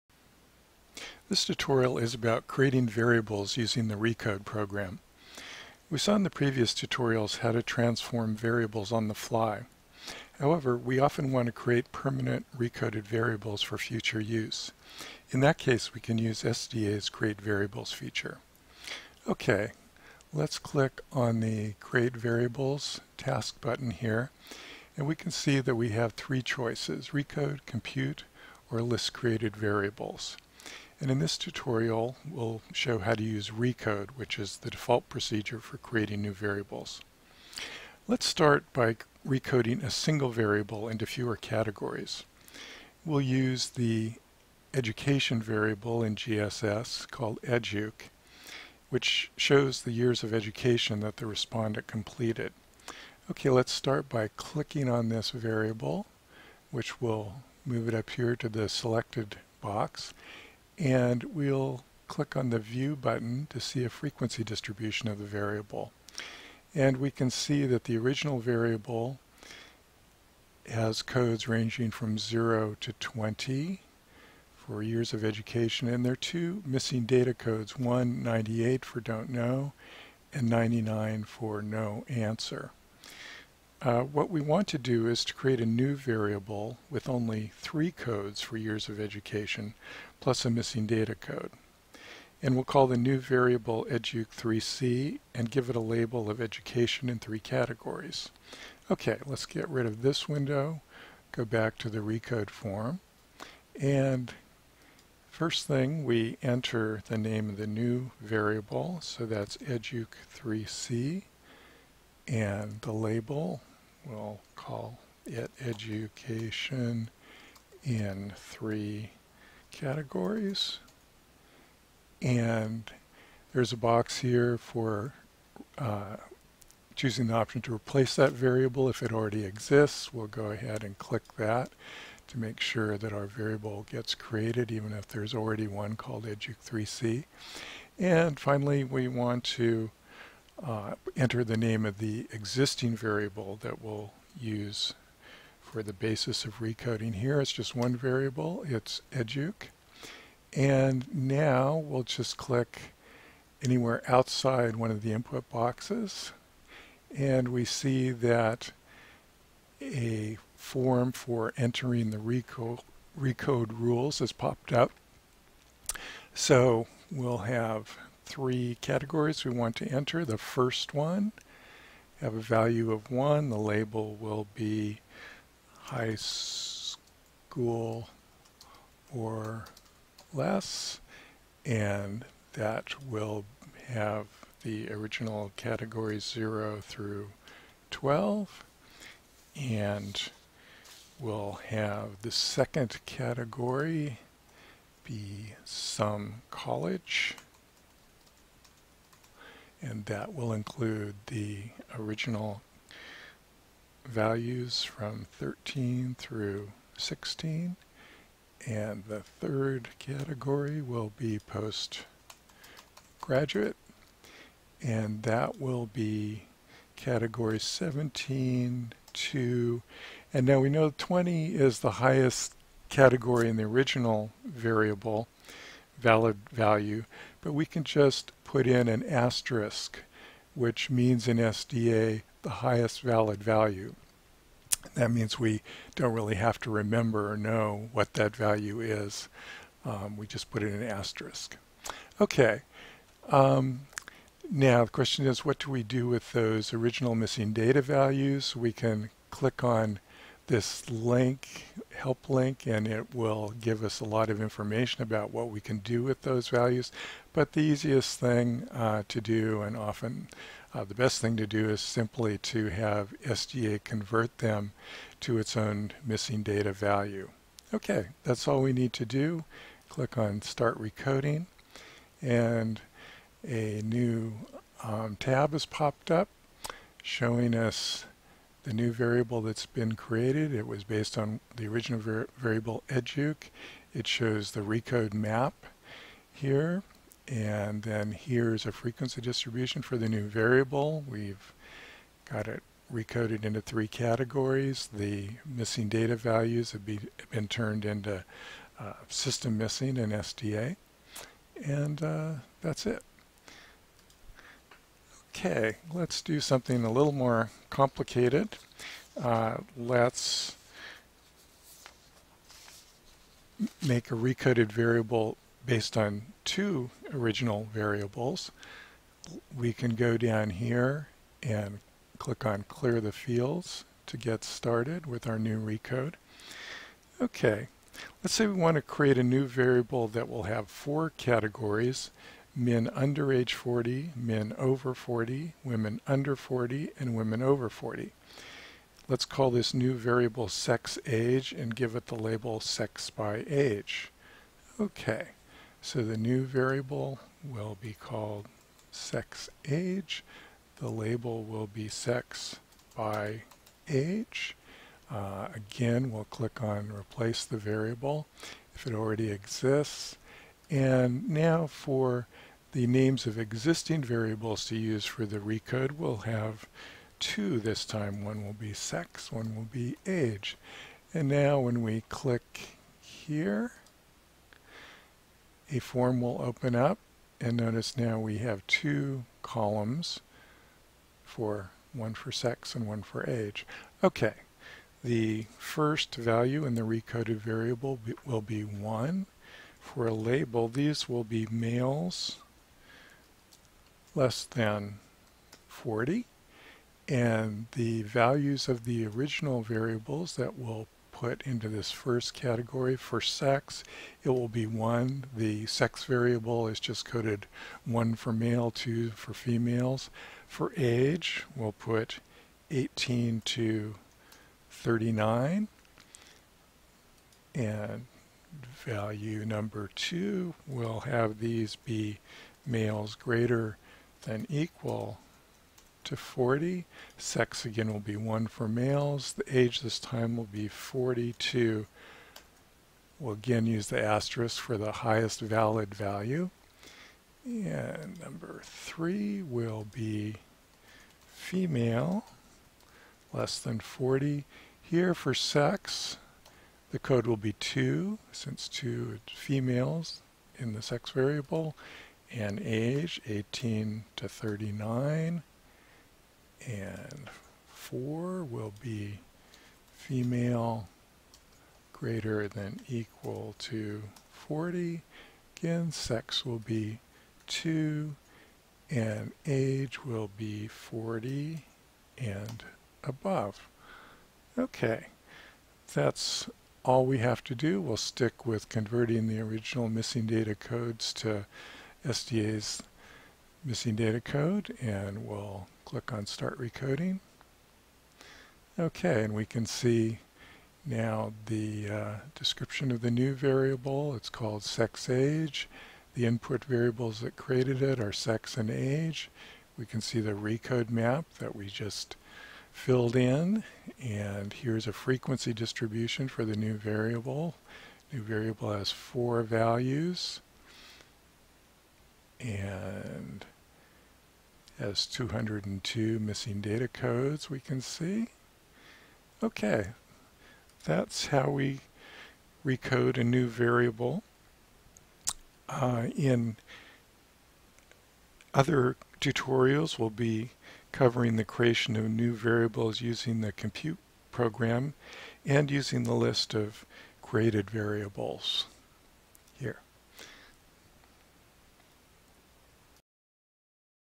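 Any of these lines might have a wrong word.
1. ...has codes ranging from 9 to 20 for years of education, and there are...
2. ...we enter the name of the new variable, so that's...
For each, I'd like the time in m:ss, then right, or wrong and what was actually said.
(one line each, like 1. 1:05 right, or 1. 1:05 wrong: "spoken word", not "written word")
1. 1:10 wrong: "0", not "9"
2. 1:46 right.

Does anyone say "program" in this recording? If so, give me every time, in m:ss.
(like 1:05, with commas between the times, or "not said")
0:04, 8:54.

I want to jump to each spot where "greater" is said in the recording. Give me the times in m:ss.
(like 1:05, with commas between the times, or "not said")
7:03, 7:41.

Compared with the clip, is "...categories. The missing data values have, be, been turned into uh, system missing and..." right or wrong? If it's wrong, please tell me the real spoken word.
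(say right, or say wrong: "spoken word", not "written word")
right.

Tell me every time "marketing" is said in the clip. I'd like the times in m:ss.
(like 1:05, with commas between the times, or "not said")
not said.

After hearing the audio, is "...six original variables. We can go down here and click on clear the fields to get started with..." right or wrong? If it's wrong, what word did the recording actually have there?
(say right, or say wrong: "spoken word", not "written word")
wrong: "two", not "six".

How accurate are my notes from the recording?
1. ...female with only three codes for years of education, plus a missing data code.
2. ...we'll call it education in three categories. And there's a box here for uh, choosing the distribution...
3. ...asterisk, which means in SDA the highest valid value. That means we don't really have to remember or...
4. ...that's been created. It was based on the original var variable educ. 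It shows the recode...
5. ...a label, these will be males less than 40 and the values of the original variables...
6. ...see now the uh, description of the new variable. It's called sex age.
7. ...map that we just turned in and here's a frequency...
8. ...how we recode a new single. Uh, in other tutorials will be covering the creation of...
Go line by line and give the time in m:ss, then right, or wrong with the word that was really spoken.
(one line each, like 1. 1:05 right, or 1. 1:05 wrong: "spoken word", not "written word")
1. 1:25 wrong: "variable", not "female"
2. 1:54 wrong: "option", not "distribution"
3. 3:49 right
4. 4:39 right
5. 6:30 right
6. 8:09 right
7. 8:20 wrong: "filled", not "turned"
8. 8:41 wrong: "variable", not "single".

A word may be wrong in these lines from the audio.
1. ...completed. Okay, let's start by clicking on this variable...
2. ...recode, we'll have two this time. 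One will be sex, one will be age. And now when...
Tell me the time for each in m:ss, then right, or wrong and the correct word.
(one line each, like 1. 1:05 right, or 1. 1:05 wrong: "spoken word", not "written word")
1. 0:51 right
2. 6:05 right.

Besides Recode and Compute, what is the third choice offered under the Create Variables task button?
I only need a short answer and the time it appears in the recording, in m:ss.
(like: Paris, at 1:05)
List Created Variables, at 0:28.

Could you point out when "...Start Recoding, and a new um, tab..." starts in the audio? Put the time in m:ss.
4:30.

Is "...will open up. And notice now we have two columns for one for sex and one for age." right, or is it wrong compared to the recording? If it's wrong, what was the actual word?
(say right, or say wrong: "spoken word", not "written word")
right.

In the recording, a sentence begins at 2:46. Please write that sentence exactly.
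So we'll have three categories we want to enter.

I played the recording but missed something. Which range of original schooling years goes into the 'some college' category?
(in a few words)
13 through 16.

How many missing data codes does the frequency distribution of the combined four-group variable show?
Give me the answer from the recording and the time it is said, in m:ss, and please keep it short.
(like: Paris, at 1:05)
202, at 8:35.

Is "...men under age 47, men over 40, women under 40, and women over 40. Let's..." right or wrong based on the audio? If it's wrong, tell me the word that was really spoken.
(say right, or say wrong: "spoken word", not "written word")
wrong: "40", not "47".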